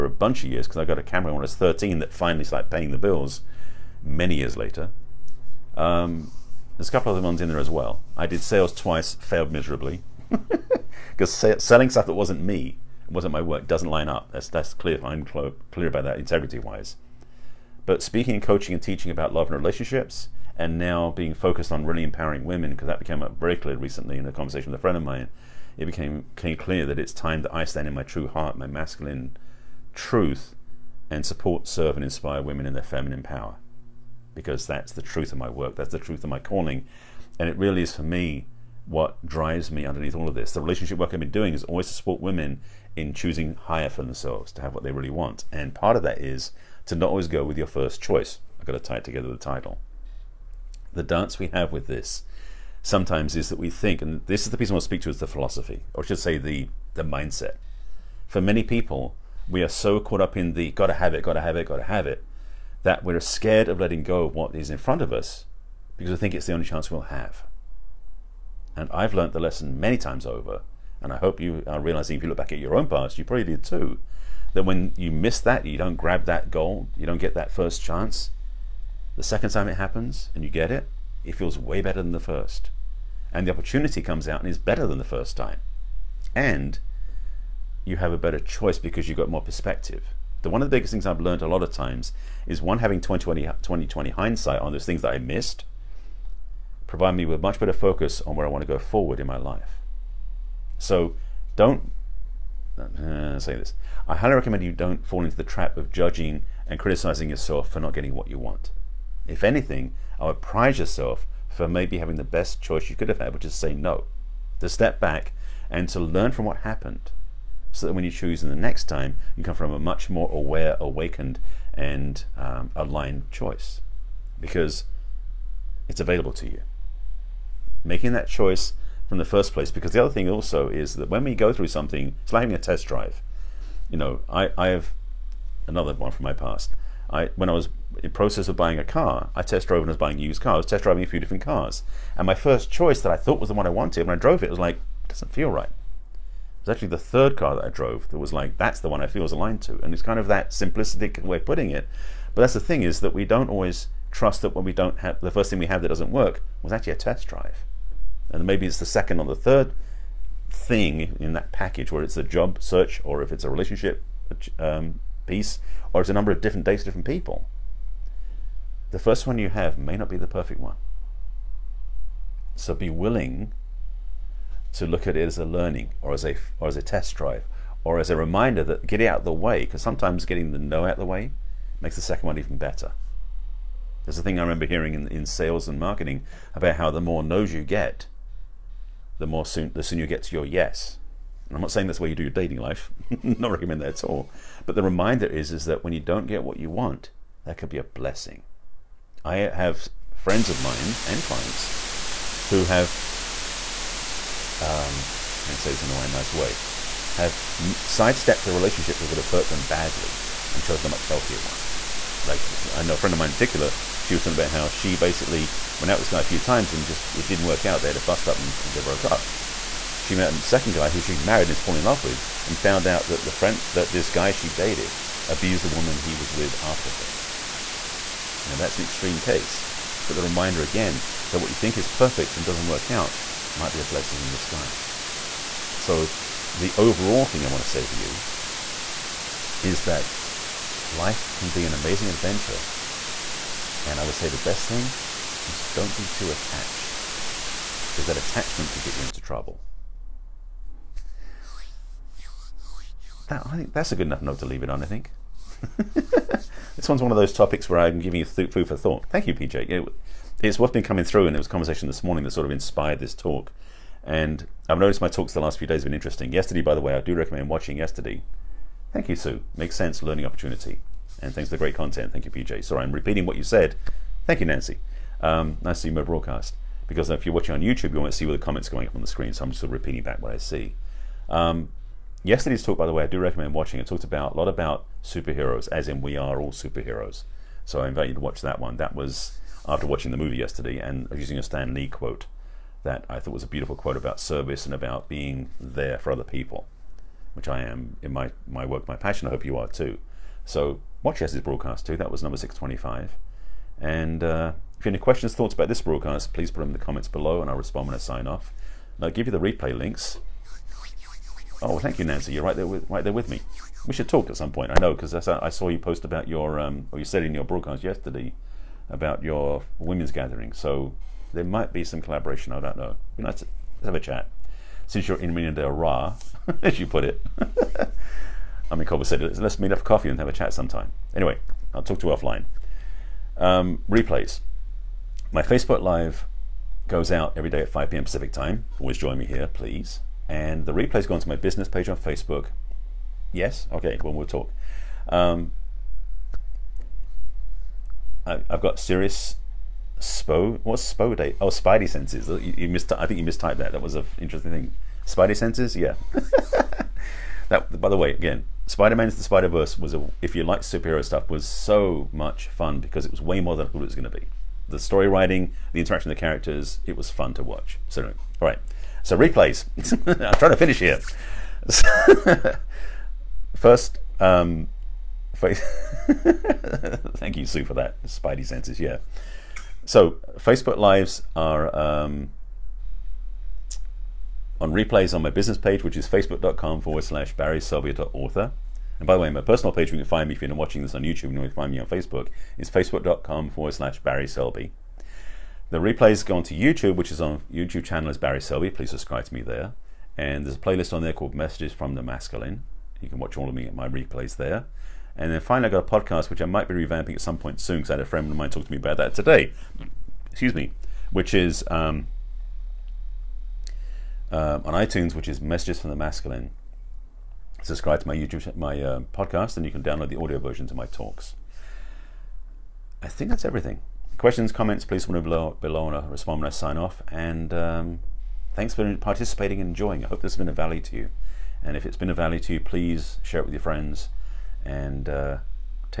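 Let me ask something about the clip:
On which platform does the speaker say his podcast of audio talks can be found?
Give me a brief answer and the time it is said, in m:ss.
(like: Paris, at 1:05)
iTunes, at 6:54.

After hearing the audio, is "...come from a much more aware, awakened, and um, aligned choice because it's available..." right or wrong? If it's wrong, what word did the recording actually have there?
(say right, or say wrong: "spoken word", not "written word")
right.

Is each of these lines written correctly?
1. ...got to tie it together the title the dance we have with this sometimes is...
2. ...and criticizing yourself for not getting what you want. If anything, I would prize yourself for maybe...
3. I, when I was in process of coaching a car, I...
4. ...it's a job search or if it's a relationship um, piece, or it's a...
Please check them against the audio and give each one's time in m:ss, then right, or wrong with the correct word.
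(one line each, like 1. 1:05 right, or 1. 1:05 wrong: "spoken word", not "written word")
1. 0:48 right
2. 1:46 right
3. 2:17 wrong: "buying", not "coaching"
4. 2:42 right.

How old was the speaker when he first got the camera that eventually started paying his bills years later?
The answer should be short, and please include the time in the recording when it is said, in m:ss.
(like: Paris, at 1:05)
13, at 0:01.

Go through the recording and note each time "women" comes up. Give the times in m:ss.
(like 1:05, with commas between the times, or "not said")
0:22, 0:32, 0:42, 5:19.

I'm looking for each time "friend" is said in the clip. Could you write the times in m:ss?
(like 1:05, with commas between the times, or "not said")
0:24, 3:20, 3:32, 3:43, 6:48, 7:13.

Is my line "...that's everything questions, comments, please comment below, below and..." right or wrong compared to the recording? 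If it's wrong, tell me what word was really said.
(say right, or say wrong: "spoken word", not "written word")
right.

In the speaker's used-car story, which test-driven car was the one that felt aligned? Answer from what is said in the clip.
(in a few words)
the third car.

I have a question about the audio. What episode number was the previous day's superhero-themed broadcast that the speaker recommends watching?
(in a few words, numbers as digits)
625.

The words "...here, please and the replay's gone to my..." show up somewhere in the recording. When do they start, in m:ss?
5:39.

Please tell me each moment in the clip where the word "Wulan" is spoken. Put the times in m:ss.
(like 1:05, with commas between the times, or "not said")
not said.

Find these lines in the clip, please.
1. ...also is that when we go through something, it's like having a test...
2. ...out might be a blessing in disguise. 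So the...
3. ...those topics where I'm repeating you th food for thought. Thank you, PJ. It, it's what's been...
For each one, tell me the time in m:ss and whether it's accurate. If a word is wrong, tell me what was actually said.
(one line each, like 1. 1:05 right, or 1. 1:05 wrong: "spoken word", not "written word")
1. 2:10 right
2. 3:52 right
3. 4:17 wrong: "giving", not "repeating".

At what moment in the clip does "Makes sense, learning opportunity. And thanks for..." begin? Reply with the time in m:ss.
4:29.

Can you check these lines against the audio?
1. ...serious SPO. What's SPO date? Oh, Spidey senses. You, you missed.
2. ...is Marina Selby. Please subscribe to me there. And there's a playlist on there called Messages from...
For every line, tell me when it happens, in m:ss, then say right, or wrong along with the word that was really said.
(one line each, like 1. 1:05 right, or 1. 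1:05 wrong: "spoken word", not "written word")
1. 5:48 right
2. 6:38 wrong: "Barry", not "Marina".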